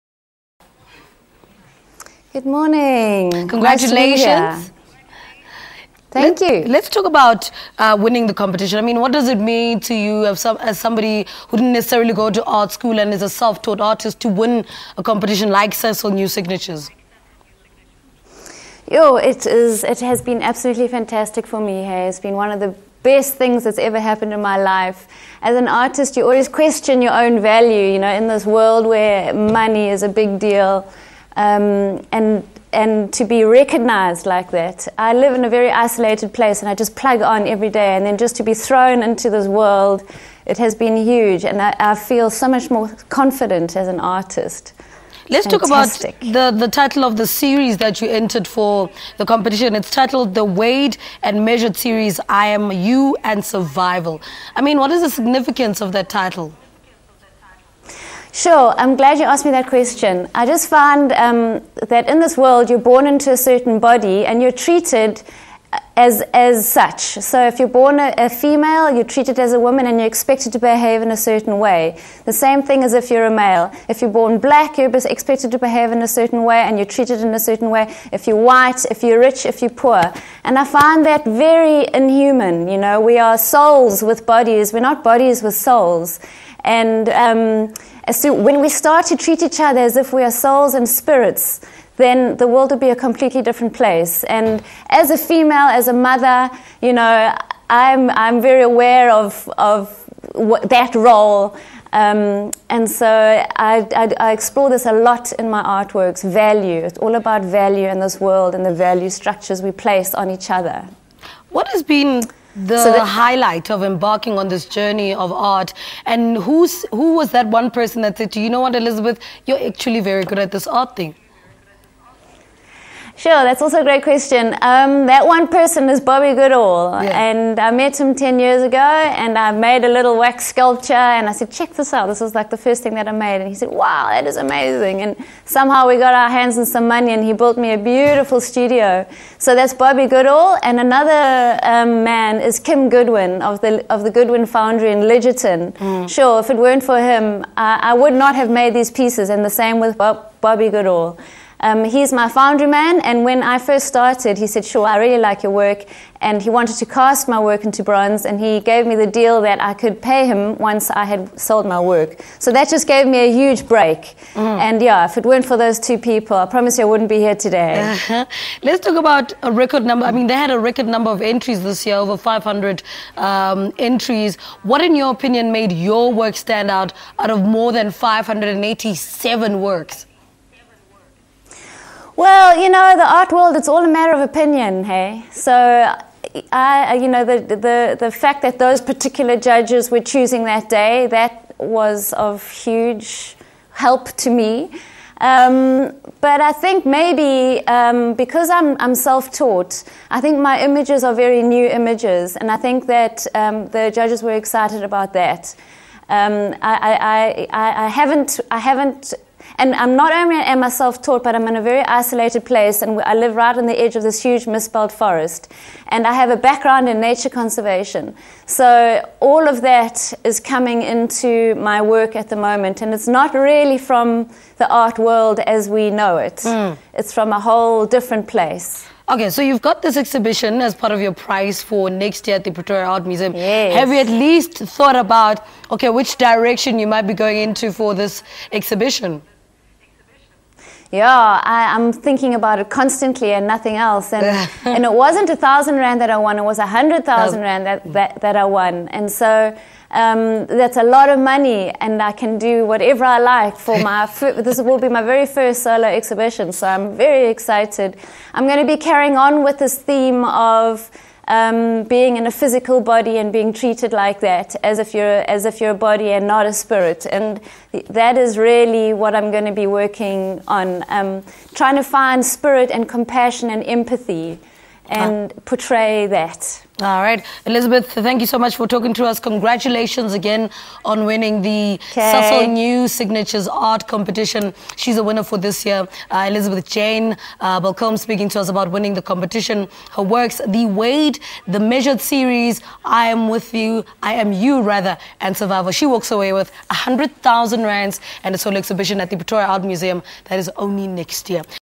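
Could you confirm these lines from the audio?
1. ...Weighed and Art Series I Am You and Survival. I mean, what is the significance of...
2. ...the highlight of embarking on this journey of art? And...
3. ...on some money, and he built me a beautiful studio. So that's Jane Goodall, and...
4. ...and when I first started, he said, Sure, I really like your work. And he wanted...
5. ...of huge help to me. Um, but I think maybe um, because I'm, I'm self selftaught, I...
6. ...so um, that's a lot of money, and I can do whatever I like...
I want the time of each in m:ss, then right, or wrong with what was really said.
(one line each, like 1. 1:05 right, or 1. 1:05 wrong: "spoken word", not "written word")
1. 0:50 wrong: "Measured", not "Art"
2. 1:52 right
3. 2:16 wrong: "Bobby", not "Jane"
4. 2:33 right
5. 3:12 wrong: "taught", not "selftaught"
6. 4:09 right.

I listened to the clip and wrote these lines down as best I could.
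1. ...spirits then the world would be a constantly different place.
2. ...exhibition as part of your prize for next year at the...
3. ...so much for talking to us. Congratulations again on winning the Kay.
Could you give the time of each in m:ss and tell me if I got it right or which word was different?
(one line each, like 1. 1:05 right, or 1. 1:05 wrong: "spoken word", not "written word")
1. 1:30 wrong: "completely", not "constantly"
2. 3:49 right
3. 4:38 right.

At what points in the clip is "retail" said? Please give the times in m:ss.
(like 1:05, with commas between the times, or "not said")
not said.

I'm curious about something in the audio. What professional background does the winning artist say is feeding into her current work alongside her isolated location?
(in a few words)
Nature conservation.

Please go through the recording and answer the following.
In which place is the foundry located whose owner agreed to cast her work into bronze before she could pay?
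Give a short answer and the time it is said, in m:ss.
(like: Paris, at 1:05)
Lidgetton, at 2:25.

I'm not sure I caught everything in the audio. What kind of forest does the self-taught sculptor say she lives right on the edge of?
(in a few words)
Mistbelt forest.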